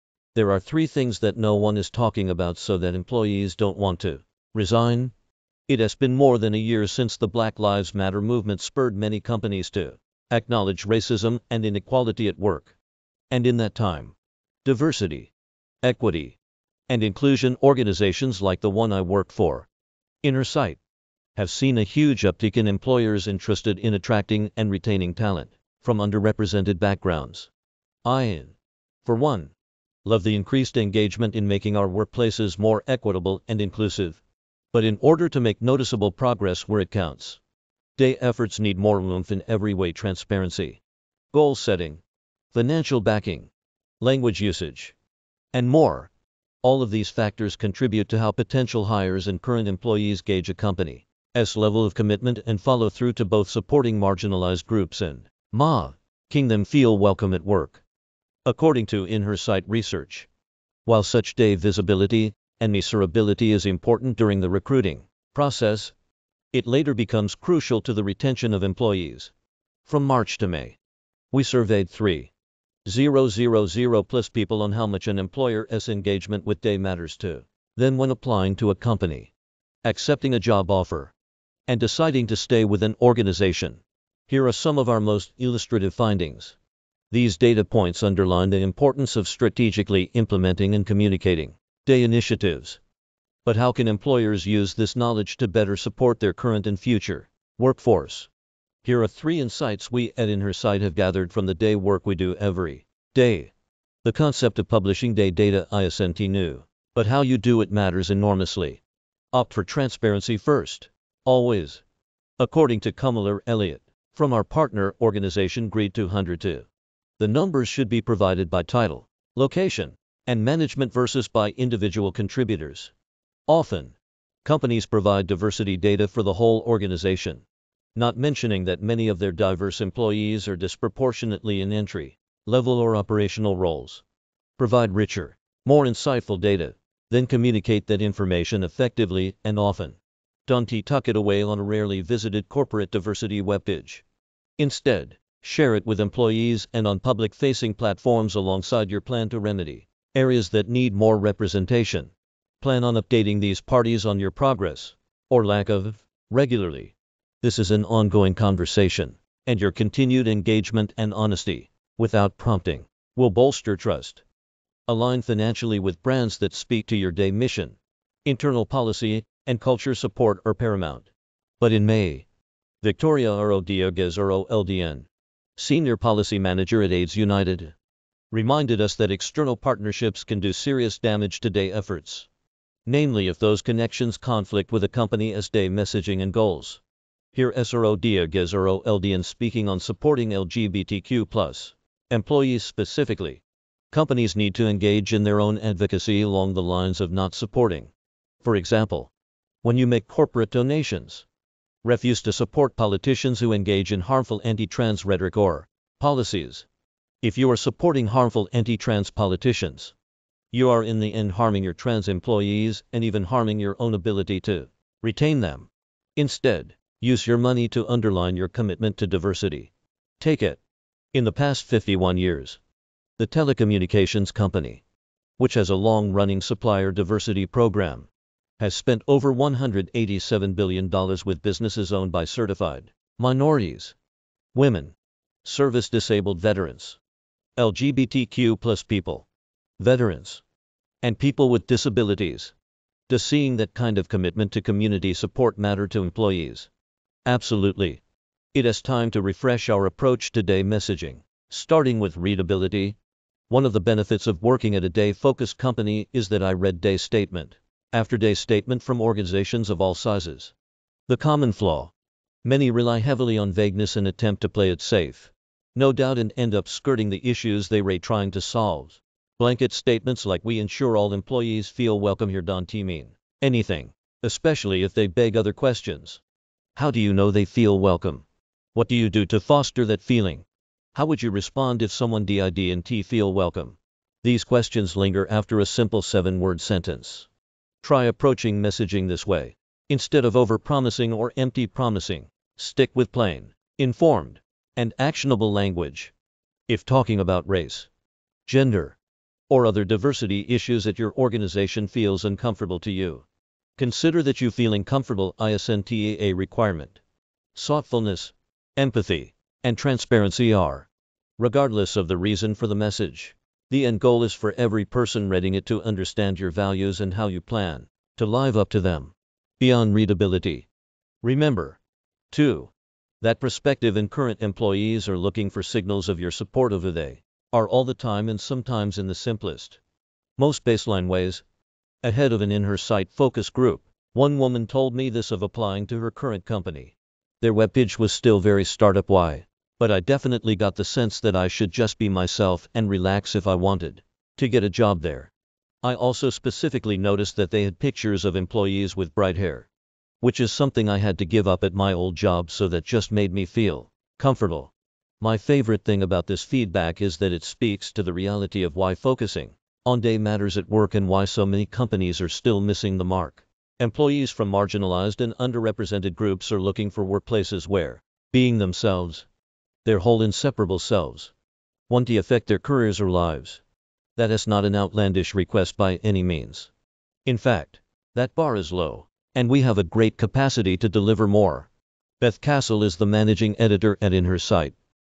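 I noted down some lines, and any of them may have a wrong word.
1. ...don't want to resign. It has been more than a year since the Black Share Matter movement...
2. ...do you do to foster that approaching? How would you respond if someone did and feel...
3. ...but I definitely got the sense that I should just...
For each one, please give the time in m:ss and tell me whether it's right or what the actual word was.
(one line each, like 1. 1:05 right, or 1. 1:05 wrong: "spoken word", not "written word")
1. 0:03 wrong: "Lives", not "Share"
2. 4:38 wrong: "feeling", not "approaching"
3. 5:39 right.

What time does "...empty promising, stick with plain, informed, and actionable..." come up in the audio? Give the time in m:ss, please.
4:51.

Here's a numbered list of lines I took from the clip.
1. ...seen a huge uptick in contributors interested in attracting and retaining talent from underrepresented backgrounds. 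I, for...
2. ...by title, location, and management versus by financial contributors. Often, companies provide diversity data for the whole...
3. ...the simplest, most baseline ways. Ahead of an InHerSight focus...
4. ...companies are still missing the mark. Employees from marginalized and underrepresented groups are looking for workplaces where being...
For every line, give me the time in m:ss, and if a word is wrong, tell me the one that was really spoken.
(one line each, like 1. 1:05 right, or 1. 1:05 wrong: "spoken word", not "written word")
1. 0:21 wrong: "employers", not "contributors"
2. 1:58 wrong: "individual", not "financial"
3. 5:29 right
4. 6:01 right.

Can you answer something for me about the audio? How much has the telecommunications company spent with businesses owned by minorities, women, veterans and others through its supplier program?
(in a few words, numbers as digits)
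$187 billion.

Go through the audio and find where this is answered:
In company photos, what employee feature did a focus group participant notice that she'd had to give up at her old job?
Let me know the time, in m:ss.
5:49.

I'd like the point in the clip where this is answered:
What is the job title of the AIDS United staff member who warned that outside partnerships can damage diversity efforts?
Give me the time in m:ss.
2:55.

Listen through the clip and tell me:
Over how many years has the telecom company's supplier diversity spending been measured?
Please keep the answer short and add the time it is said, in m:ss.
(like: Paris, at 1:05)
51, at 3:41.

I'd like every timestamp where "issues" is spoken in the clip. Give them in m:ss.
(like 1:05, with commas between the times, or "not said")
4:27, 5:00.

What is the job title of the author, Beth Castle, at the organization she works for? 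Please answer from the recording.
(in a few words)
managing editor.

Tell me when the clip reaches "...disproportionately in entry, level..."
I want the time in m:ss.
2:10.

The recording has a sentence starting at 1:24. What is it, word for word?
Here are some of our most illustrative findings.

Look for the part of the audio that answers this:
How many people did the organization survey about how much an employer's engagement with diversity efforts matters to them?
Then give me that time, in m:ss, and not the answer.
1:11.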